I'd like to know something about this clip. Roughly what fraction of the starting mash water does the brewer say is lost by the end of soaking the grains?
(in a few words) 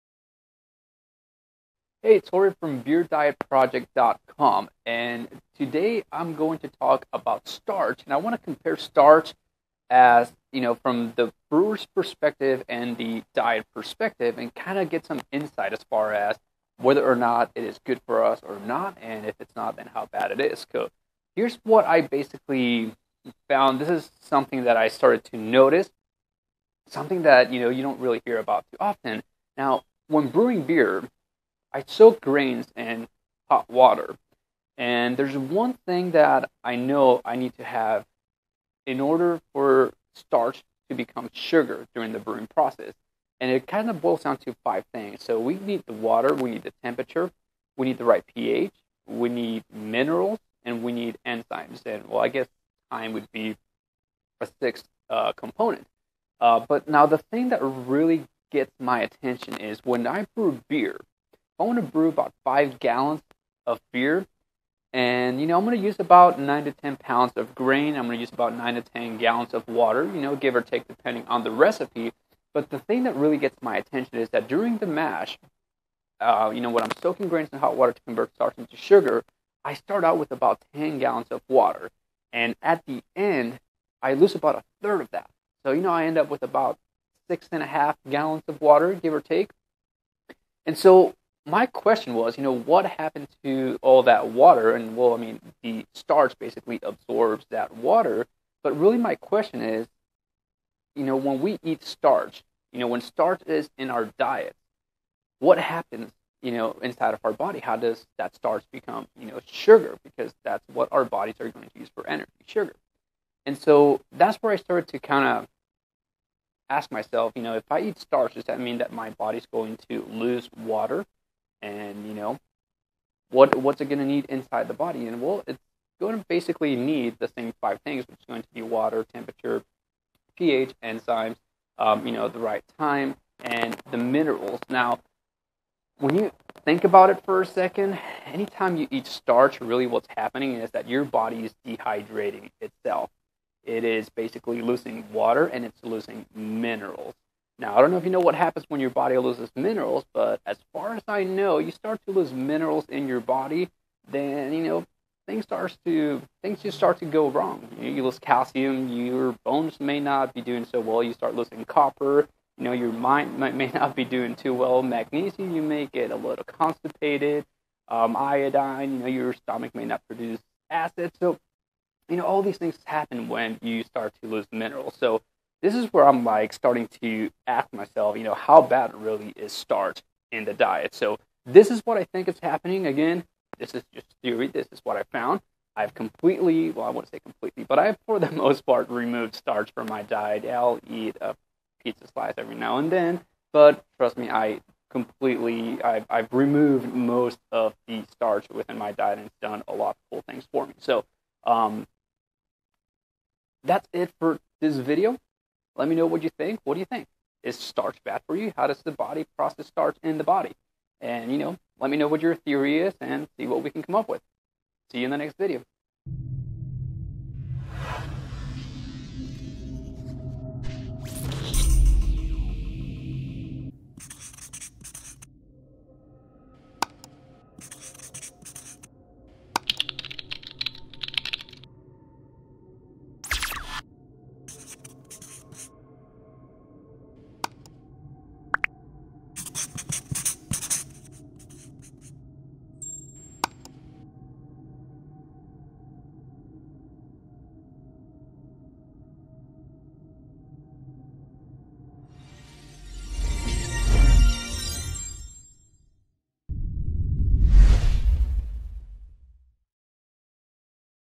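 a third.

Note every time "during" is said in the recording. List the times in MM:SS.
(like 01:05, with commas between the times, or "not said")
00:41, 01:14.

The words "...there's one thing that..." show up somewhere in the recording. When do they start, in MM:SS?
00:35.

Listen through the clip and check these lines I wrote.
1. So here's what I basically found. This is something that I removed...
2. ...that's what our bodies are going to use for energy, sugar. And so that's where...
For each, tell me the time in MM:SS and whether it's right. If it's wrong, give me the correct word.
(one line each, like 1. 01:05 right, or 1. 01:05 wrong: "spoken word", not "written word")
1. 00:20 wrong: "started", not "removed"
2. 01:50 right.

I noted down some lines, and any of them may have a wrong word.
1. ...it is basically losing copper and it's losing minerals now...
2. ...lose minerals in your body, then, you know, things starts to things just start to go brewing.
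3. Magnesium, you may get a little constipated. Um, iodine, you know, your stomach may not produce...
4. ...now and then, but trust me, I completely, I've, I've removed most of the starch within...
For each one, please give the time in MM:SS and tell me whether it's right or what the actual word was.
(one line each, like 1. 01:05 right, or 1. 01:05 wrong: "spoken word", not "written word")
1. 02:23 wrong: "water", not "copper"
2. 02:32 wrong: "wrong", not "brewing"
3. 02:44 right
4. 03:12 right.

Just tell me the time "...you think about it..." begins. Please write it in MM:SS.
02:16.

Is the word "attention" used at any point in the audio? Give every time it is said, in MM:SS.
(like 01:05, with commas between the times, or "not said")
00:59, 01:13.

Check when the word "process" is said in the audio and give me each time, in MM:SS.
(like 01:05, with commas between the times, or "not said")
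00:42, 03:29.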